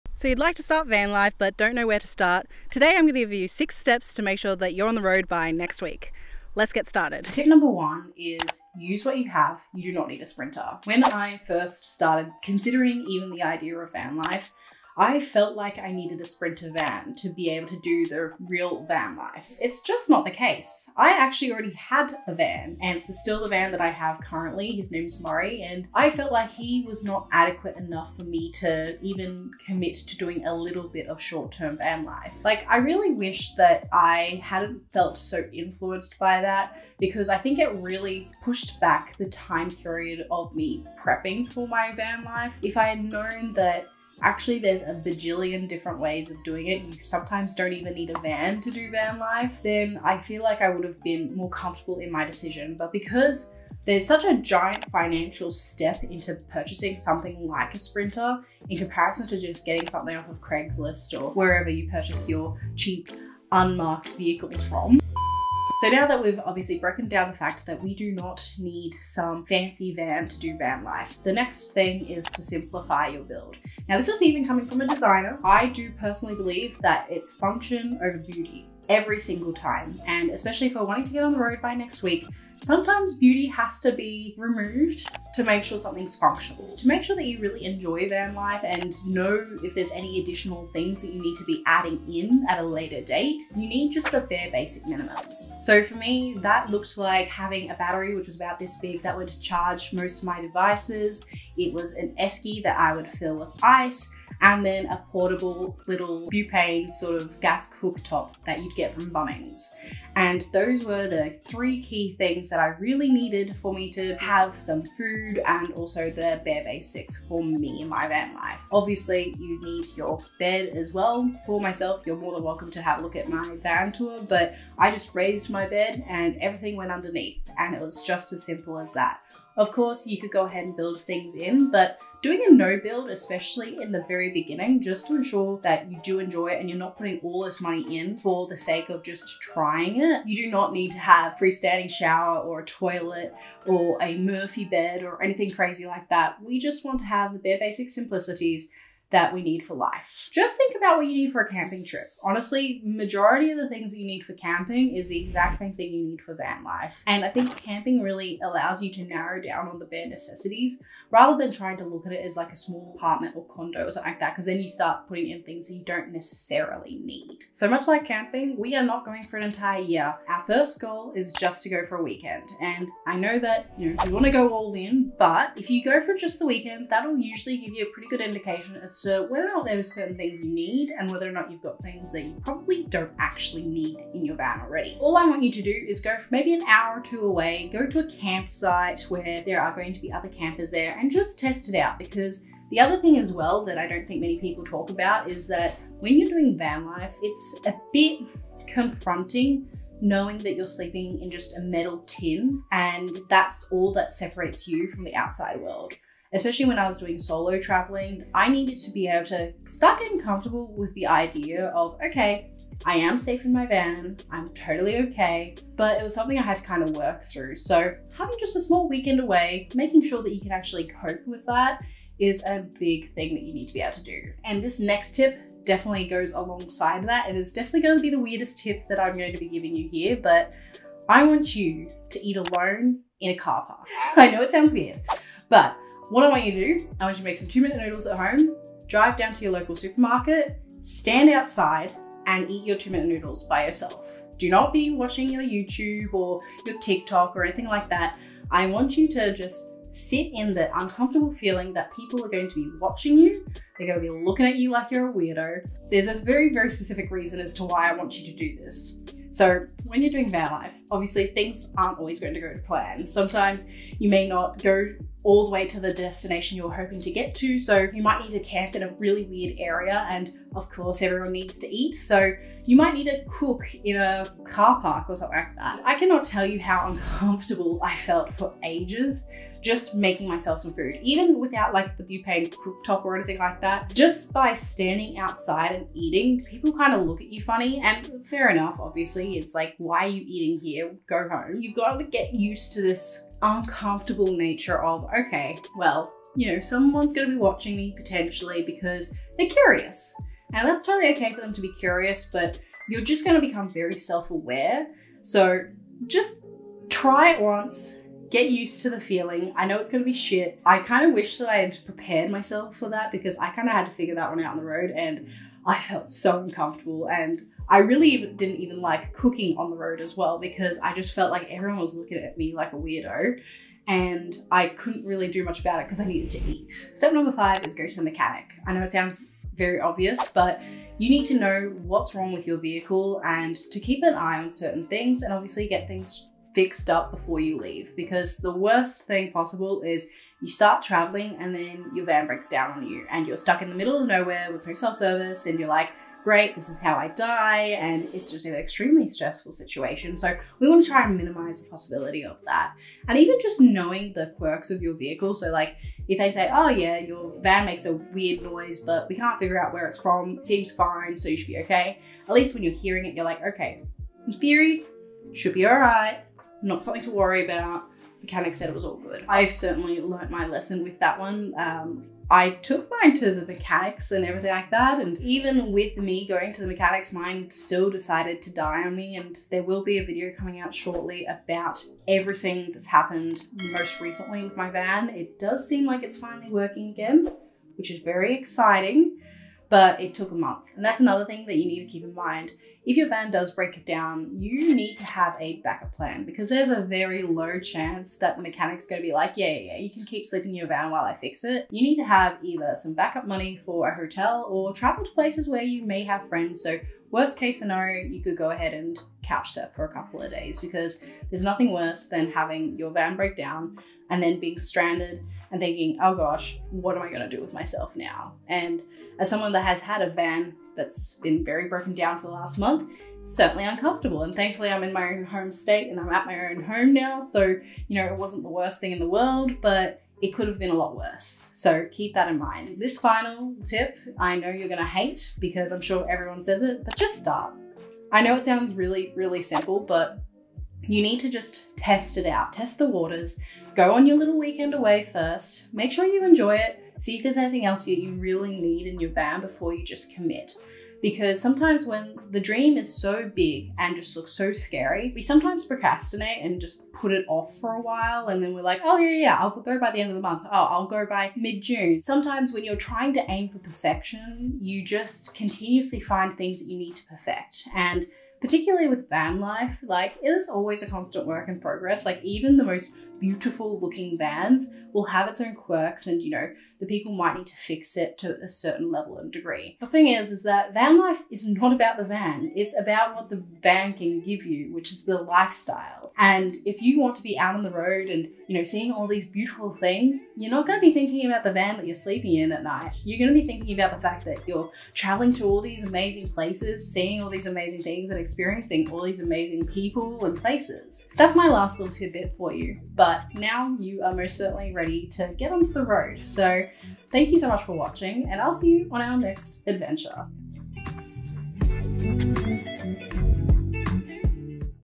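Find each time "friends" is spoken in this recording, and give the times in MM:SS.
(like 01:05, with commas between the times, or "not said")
06:46.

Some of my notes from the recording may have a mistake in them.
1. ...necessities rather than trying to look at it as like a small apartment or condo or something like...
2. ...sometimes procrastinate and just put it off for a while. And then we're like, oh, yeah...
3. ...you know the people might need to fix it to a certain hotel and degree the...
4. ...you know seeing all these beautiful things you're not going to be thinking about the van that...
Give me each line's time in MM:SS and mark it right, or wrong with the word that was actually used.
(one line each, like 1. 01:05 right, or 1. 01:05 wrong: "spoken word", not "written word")
1. 02:40 right
2. 07:35 right
3. 07:56 wrong: "level", not "hotel"
4. 08:08 right.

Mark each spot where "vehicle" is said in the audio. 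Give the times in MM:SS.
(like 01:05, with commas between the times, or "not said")
01:04, 05:32, 05:54.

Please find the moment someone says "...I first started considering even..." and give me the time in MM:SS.
00:11.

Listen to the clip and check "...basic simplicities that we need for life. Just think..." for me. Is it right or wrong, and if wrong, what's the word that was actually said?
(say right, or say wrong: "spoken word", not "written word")
right.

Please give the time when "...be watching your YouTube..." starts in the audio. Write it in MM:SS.
04:04.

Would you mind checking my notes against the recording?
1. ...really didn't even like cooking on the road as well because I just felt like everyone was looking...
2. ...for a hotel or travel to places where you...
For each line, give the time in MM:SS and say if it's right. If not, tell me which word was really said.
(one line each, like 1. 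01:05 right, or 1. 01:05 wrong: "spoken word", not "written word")
1. 05:17 right
2. 06:43 right.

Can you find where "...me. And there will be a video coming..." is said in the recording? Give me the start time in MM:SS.
06:18.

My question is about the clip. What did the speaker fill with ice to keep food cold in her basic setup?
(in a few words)
An esky.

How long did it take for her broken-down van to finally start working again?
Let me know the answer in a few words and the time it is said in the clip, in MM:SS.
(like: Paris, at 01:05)
A month, at 06:30.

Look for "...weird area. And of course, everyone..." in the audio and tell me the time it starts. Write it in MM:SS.
04:29.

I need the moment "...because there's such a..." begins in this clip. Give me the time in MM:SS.
00:52.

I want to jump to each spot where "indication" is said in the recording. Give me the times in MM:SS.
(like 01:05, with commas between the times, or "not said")
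02:58.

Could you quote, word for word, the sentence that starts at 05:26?
Step number five is go to the mechanic.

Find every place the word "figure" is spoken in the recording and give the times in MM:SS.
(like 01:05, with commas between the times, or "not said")
05:13, 05:59.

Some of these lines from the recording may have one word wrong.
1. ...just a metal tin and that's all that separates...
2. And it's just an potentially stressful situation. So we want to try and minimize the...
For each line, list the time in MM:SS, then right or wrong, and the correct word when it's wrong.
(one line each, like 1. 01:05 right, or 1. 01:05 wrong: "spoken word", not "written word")
1. 03:21 right
2. 05:47 wrong: "extremely", not "potentially".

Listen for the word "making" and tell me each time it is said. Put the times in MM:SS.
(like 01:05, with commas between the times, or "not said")
03:39, 04:39.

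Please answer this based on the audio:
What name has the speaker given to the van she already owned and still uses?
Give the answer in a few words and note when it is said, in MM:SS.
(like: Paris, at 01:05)
Murray, at 00:25.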